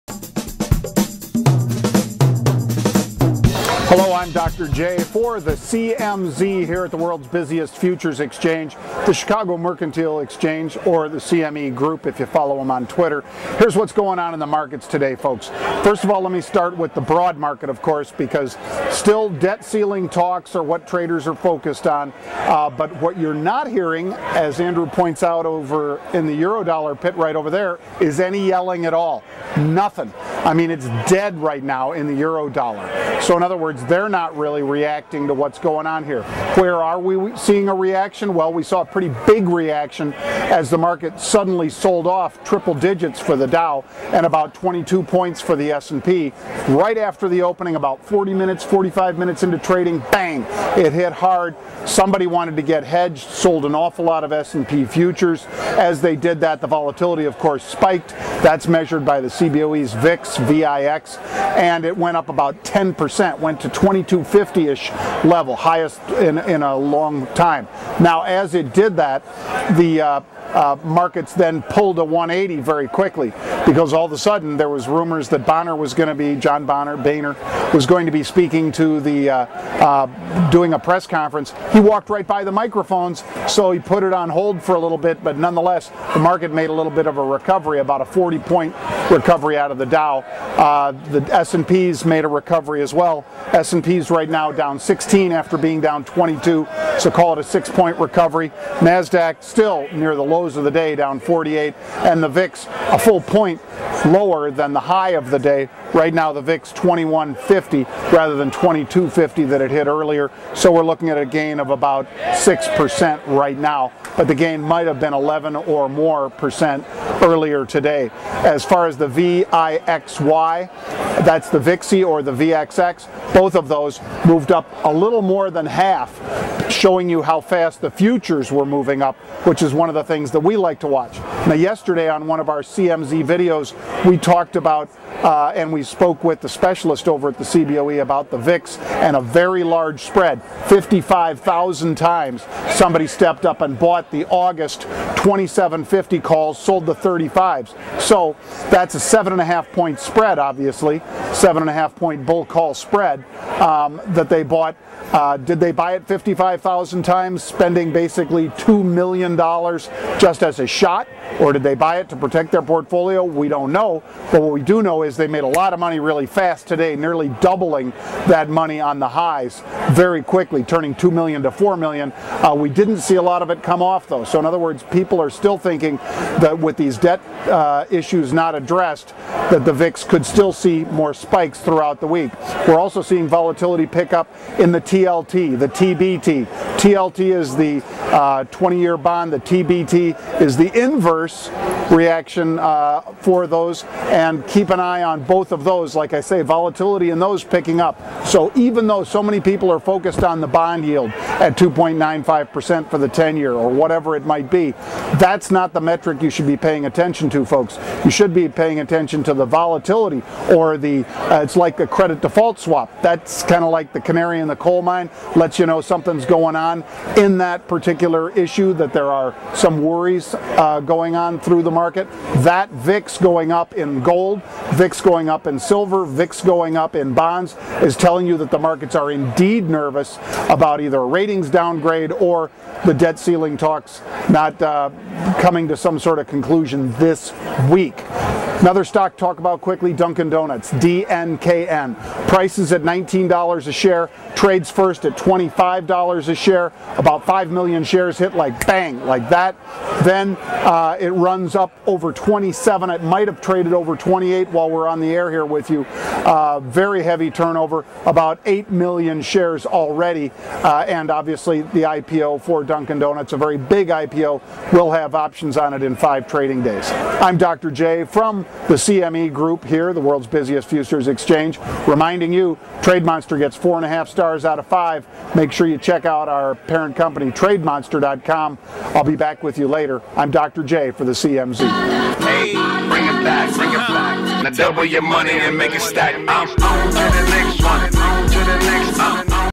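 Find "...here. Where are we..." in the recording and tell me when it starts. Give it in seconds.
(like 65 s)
36 s.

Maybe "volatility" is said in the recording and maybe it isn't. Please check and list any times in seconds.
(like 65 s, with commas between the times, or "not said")
56 s, 183 s, 196 s, 209 s.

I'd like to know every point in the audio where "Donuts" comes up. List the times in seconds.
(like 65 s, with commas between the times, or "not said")
240 s, 262 s.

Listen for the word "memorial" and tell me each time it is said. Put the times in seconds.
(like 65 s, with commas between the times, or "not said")
not said.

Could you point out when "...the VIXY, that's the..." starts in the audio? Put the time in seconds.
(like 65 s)
118 s.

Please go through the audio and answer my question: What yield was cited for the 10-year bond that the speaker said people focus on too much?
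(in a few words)
2.95%.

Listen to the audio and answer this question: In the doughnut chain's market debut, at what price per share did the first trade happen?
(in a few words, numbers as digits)
$25.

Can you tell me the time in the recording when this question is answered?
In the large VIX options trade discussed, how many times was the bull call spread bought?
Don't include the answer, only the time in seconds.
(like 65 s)
140 s.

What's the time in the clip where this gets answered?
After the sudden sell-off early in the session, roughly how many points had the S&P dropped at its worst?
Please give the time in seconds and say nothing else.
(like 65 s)
44 s.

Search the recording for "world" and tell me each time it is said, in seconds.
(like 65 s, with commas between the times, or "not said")
6 s, 270 s.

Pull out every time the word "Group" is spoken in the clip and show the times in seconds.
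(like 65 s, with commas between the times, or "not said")
11 s, 269 s.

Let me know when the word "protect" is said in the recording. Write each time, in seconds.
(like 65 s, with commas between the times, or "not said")
162 s.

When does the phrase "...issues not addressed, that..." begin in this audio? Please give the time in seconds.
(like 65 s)
177 s.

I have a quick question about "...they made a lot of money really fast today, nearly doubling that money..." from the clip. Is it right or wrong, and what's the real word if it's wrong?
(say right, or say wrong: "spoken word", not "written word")
right.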